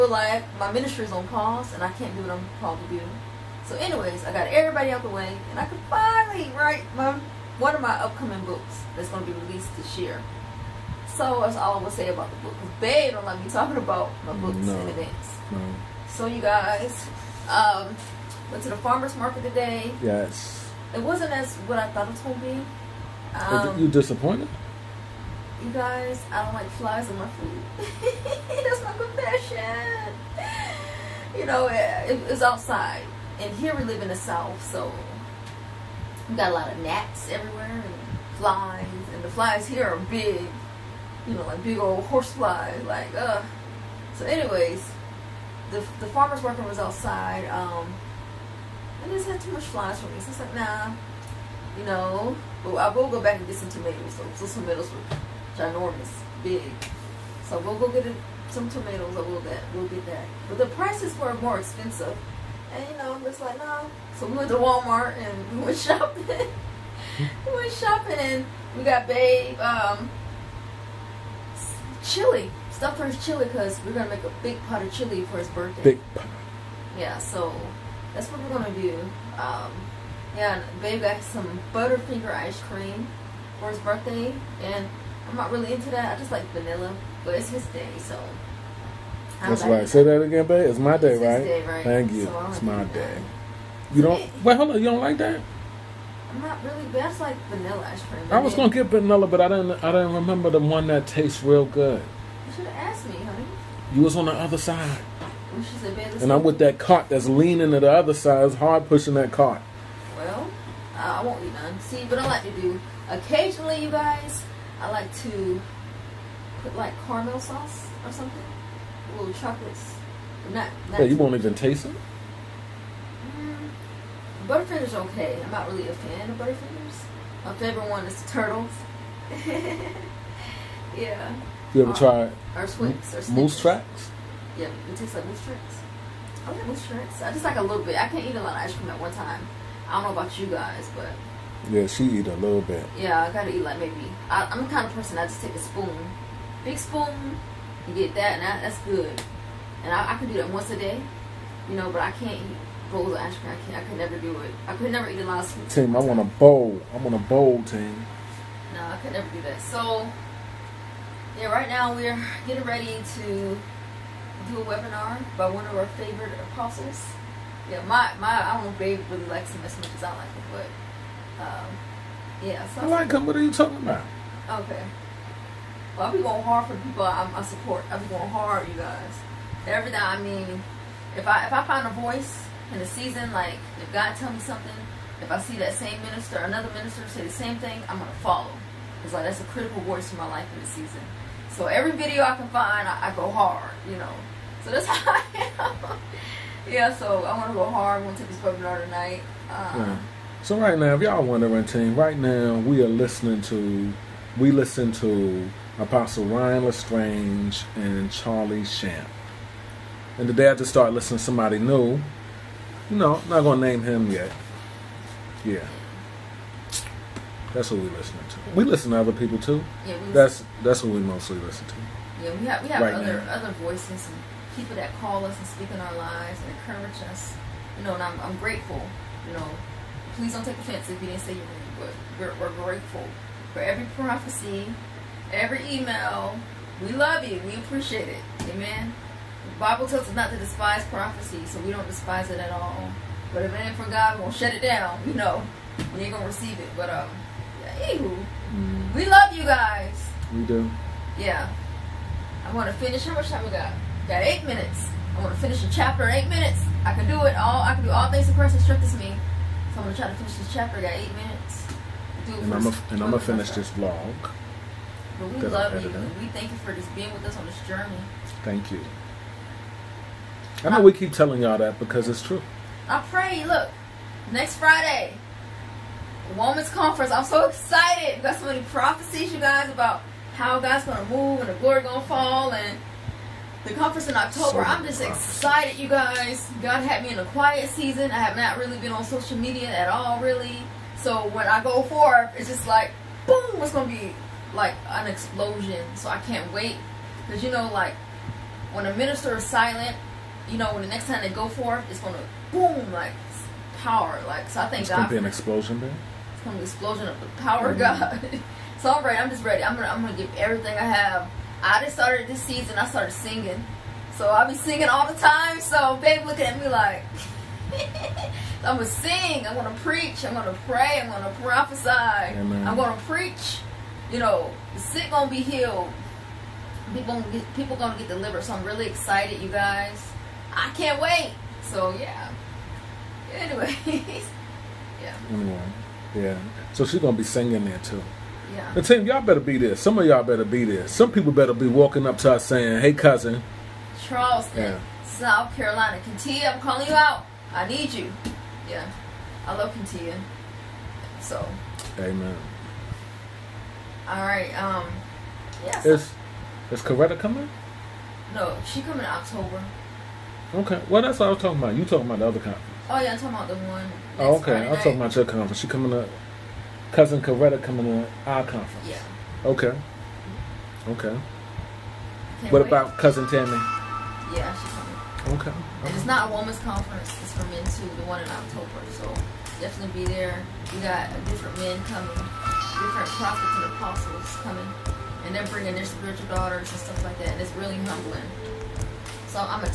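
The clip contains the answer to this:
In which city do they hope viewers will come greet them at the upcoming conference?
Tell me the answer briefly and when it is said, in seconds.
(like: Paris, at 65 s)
Charleston, at 344 s.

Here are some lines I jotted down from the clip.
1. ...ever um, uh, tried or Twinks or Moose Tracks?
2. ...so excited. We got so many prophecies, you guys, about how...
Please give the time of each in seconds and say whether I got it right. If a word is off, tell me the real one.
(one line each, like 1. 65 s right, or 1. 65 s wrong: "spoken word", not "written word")
1. 131 s right
2. 277 s right.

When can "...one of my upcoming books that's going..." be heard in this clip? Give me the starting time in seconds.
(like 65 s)
7 s.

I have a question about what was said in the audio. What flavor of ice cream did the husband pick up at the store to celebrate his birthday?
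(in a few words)
Butterfinger.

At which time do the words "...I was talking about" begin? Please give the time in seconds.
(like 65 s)
361 s.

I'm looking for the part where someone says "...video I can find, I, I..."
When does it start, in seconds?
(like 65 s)
191 s.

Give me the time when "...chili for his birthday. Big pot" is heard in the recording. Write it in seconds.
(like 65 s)
74 s.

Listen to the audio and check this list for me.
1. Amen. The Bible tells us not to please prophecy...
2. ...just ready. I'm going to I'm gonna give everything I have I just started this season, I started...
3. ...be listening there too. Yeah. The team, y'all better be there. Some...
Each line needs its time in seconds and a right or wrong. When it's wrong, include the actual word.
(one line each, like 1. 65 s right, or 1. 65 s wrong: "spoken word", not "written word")
1. 238 s wrong: "despise", not "please"
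2. 309 s right
3. 337 s wrong: "singing", not "listening".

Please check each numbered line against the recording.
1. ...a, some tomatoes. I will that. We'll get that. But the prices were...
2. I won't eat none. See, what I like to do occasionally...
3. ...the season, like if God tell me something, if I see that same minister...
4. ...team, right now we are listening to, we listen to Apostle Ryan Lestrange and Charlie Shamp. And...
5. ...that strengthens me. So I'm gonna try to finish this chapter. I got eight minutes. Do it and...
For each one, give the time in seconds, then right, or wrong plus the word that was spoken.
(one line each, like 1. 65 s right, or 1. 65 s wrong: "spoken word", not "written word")
1. 58 s right
2. 111 s right
3. 182 s right
4. 201 s right
5. 258 s right.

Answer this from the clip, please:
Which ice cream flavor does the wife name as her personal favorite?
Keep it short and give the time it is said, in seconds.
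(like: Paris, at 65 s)
Turtles, at 128 s.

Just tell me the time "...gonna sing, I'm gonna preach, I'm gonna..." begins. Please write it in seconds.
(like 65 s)
318 s.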